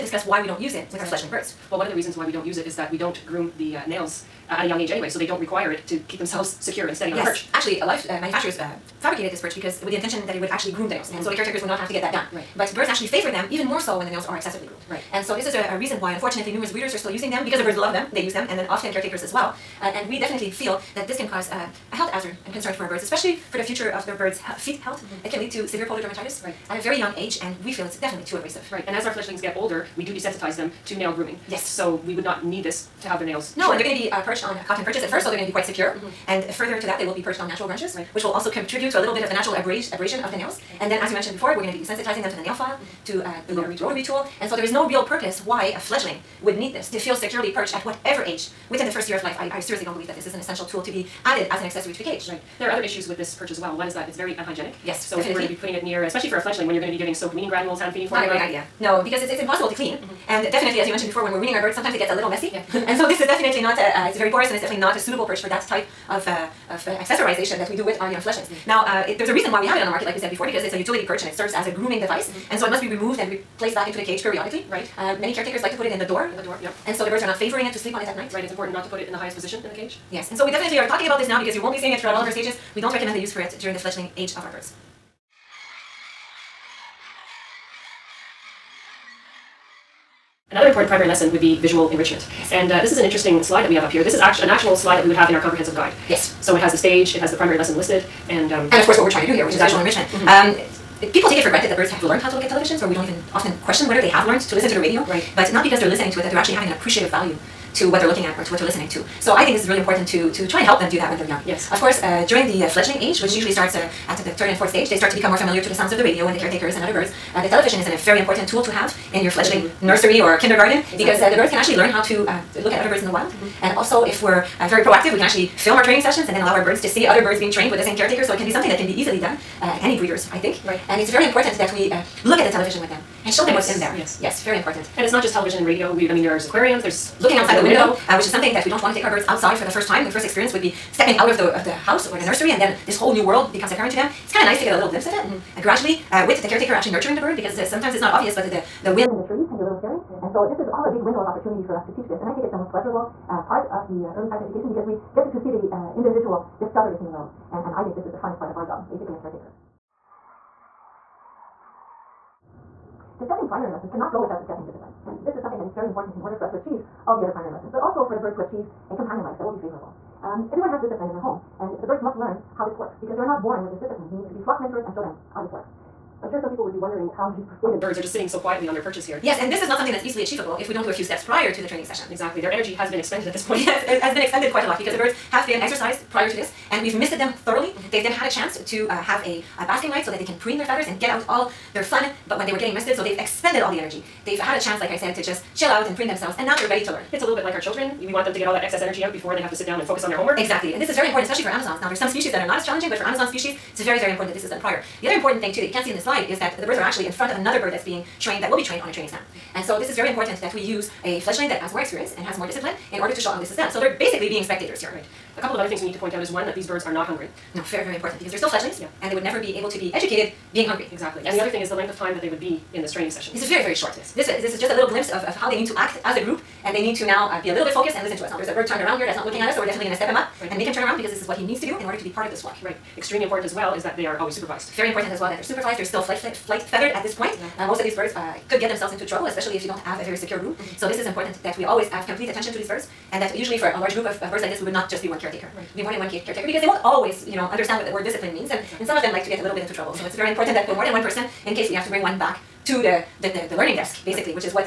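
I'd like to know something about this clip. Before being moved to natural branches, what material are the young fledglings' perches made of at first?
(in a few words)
Cotton.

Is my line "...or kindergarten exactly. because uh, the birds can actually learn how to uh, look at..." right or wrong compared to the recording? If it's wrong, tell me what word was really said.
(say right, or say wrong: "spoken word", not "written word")
right.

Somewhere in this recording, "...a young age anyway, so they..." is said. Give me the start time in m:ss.
0:04.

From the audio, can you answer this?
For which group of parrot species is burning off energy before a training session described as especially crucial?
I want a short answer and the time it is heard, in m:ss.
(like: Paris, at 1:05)
Amazons, at 3:21.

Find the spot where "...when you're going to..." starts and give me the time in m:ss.
0:56.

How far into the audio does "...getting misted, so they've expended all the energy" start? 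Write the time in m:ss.
3:12.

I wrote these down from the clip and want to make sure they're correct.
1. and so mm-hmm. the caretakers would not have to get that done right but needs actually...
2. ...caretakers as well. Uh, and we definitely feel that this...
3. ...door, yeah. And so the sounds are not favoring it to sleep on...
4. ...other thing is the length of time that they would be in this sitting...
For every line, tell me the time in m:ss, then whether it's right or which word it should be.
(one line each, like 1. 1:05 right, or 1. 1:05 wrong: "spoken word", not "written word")
1. 0:11 wrong: "birds", not "needs"
2. 0:18 right
3. 1:16 wrong: "birds", not "sounds"
4. 3:41 wrong: "training", not "sitting".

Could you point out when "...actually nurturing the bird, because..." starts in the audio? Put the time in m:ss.
2:26.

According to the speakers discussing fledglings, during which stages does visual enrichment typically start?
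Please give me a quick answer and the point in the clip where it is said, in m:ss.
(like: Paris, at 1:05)
Third and fourth, at 1:54.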